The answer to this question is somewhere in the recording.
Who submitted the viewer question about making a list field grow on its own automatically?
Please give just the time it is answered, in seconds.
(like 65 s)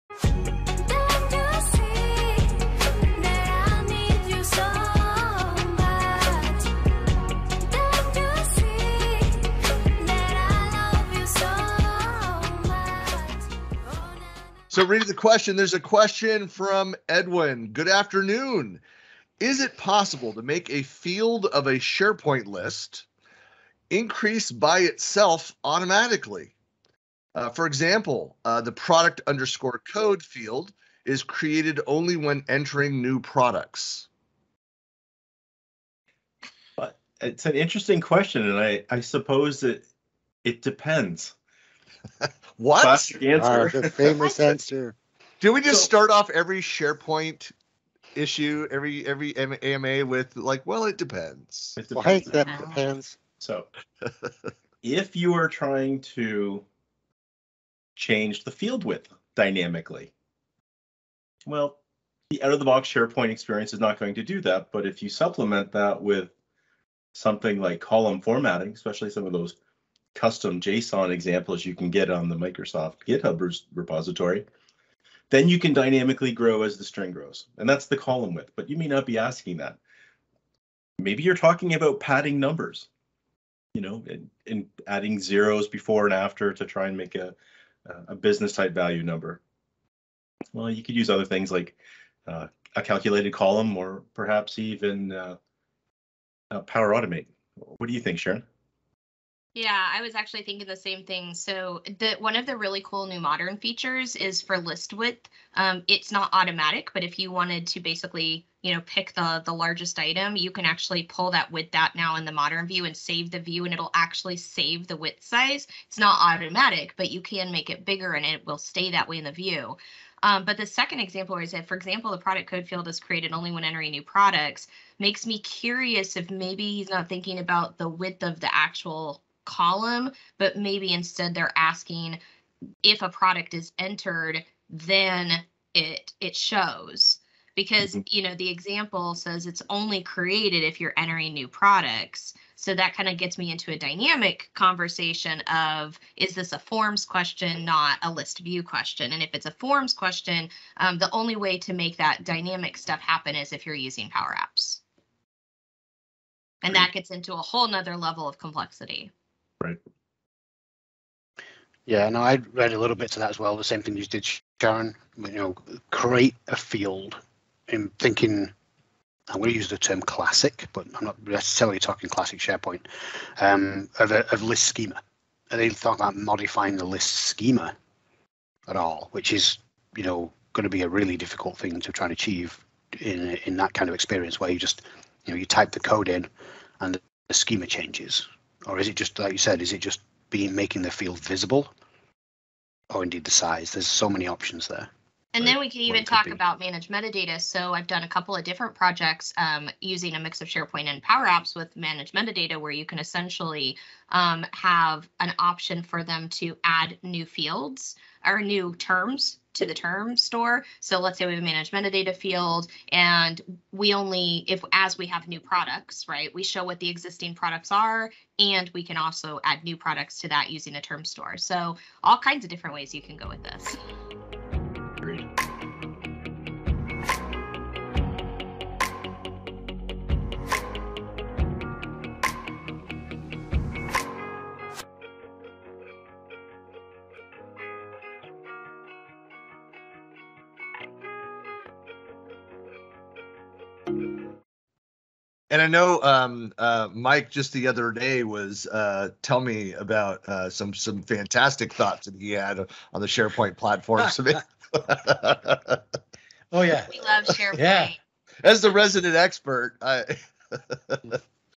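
17 s.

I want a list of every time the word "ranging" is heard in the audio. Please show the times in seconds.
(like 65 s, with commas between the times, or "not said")
not said.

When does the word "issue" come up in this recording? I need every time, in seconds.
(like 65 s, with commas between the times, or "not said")
48 s.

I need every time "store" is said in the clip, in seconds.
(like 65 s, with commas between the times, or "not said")
210 s, 221 s.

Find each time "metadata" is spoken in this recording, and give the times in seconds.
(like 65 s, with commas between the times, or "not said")
196 s, 202 s, 211 s.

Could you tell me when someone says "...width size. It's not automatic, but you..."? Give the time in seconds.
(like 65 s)
114 s.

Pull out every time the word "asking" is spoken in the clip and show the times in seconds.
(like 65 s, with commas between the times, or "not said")
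79 s, 131 s.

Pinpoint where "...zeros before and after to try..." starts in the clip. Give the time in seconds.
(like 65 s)
85 s.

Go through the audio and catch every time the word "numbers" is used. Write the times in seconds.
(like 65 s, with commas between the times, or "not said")
82 s, 89 s.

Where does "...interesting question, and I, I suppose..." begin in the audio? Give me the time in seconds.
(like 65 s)
37 s.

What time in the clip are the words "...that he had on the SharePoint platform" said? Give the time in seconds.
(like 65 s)
252 s.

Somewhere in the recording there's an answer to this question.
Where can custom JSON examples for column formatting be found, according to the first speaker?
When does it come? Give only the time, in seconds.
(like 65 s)
72 s.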